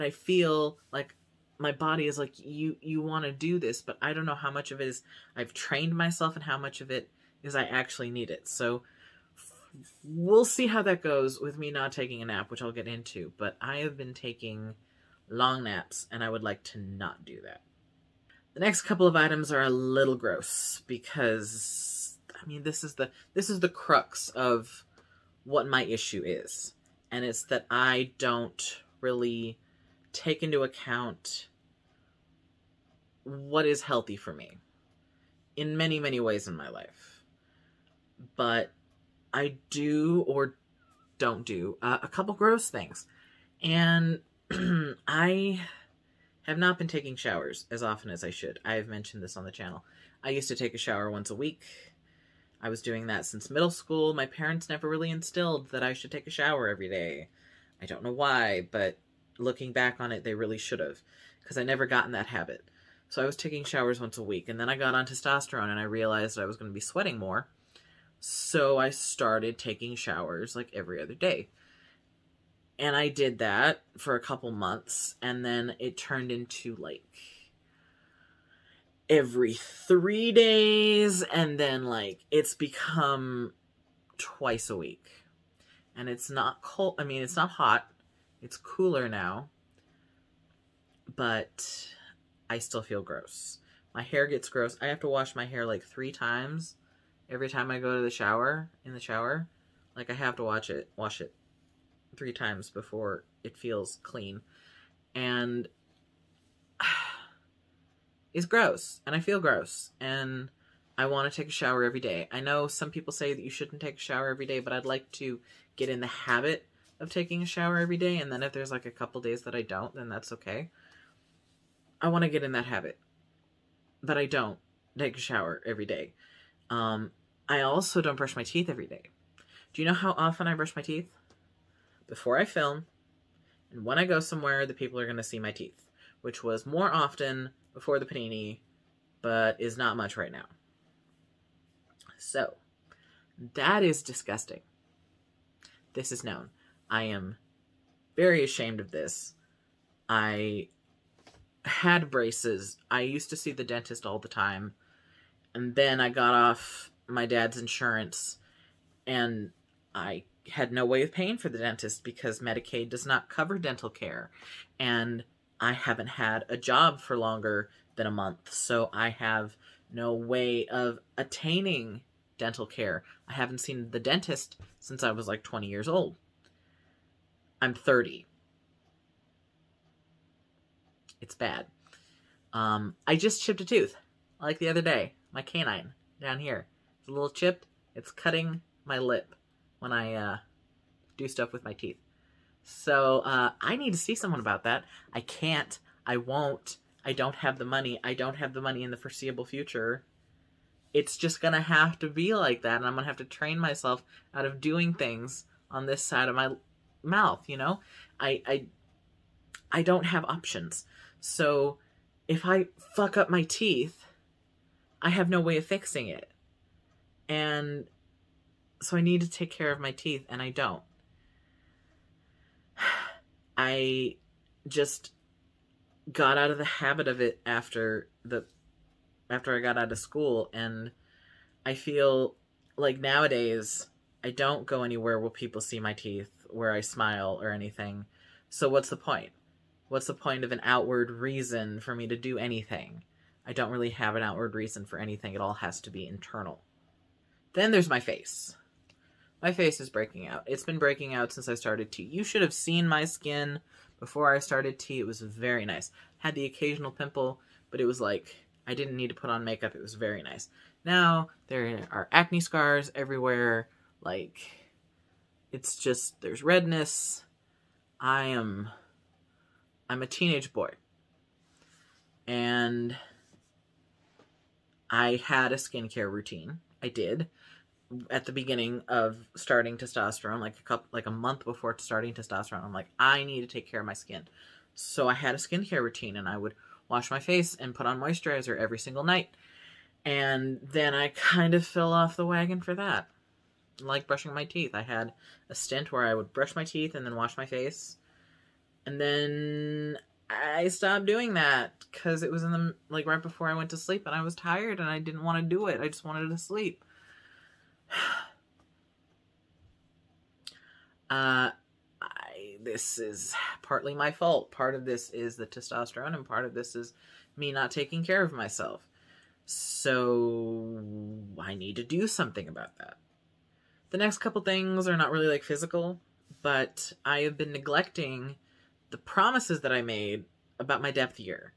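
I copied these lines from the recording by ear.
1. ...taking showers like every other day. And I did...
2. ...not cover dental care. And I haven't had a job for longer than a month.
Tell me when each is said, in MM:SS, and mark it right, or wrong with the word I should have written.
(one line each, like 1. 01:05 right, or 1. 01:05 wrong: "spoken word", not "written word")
1. 01:09 right
2. 02:43 right.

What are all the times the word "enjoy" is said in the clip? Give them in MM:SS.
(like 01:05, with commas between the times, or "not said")
not said.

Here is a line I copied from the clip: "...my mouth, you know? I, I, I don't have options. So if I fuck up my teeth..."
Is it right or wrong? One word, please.
right.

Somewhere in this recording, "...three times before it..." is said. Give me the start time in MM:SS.
01:42.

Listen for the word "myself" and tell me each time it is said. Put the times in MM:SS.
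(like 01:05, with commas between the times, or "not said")
00:05, 03:23, 05:18.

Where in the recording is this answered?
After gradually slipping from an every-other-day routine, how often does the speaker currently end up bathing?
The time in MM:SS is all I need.
01:24.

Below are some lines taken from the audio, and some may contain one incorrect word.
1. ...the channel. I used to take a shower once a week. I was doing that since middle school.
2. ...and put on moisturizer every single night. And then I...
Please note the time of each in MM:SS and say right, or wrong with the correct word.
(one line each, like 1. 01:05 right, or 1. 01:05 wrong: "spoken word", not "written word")
1. 00:49 right
2. 04:47 right.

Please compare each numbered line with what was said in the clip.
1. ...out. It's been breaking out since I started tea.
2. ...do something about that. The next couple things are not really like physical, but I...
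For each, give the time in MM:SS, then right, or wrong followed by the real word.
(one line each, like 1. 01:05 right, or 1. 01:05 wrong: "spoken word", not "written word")
1. 04:10 right
2. 05:21 right.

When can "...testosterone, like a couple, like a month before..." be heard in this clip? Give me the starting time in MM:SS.
04:39.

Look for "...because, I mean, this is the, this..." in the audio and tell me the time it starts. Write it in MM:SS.
00:20.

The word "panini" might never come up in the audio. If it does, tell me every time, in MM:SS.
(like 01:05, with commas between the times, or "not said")
02:18.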